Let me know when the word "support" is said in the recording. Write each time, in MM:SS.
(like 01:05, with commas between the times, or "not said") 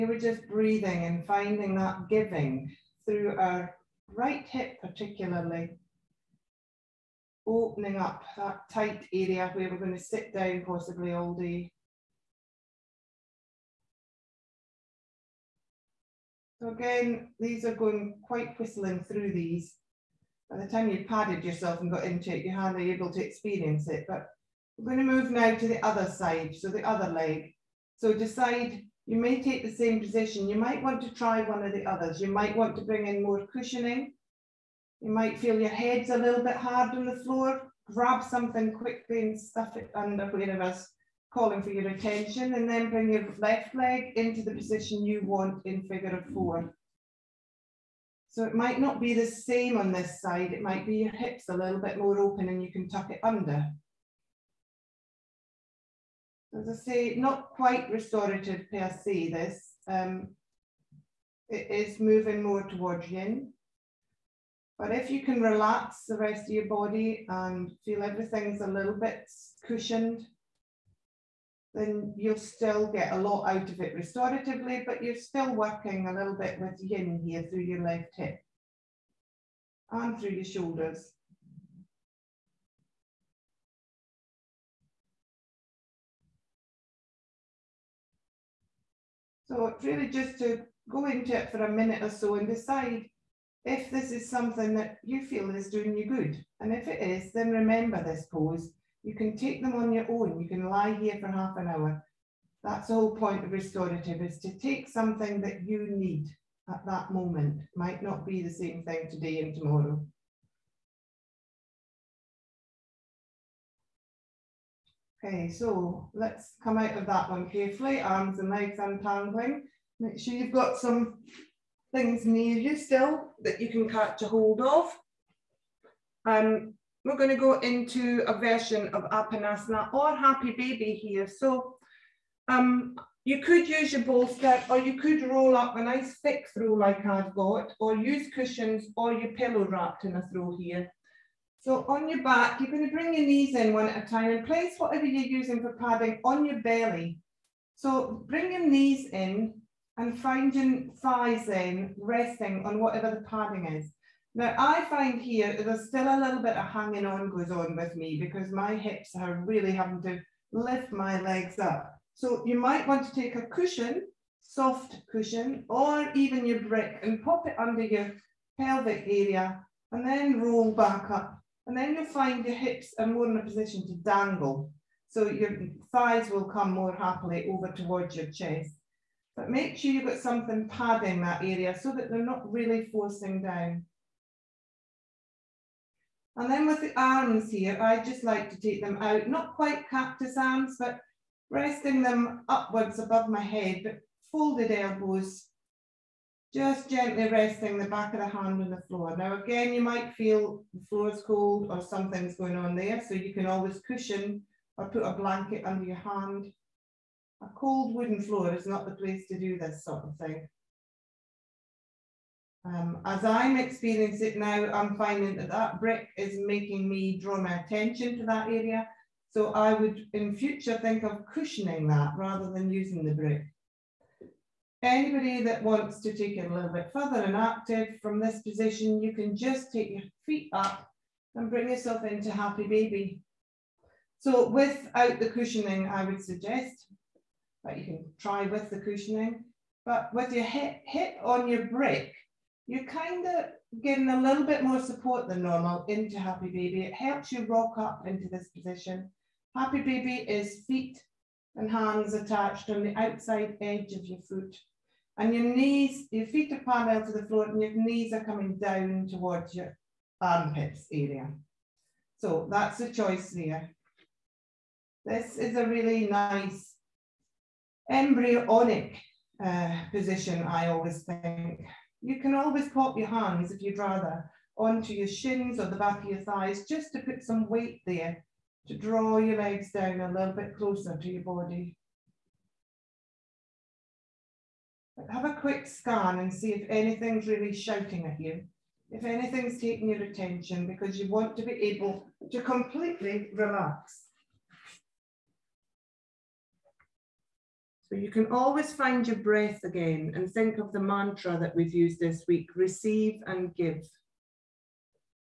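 04:04.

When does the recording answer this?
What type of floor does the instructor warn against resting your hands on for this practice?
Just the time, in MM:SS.
03:27.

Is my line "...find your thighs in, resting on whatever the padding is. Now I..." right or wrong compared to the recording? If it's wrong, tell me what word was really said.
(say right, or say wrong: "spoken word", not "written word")
right.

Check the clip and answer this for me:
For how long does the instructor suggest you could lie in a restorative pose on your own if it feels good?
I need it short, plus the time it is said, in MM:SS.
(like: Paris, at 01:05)
half an hour, at 01:41.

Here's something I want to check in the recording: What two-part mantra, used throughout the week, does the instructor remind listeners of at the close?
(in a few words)
receive and give.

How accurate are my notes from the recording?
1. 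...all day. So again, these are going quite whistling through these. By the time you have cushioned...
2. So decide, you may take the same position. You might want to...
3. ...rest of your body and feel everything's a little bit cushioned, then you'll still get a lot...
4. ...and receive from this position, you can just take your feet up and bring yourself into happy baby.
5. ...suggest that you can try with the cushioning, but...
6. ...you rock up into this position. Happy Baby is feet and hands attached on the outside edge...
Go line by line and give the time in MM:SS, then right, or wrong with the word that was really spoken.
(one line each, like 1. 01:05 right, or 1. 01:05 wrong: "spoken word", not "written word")
1. 00:11 wrong: "padded", not "cushioned"
2. 00:27 right
3. 01:06 right
4. 03:47 wrong: "active", not "receive"
5. 03:56 right
6. 04:07 right.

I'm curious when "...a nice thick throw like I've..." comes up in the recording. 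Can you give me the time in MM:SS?
02:15.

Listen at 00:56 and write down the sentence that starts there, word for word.
As I say, not quite restorative per se, this.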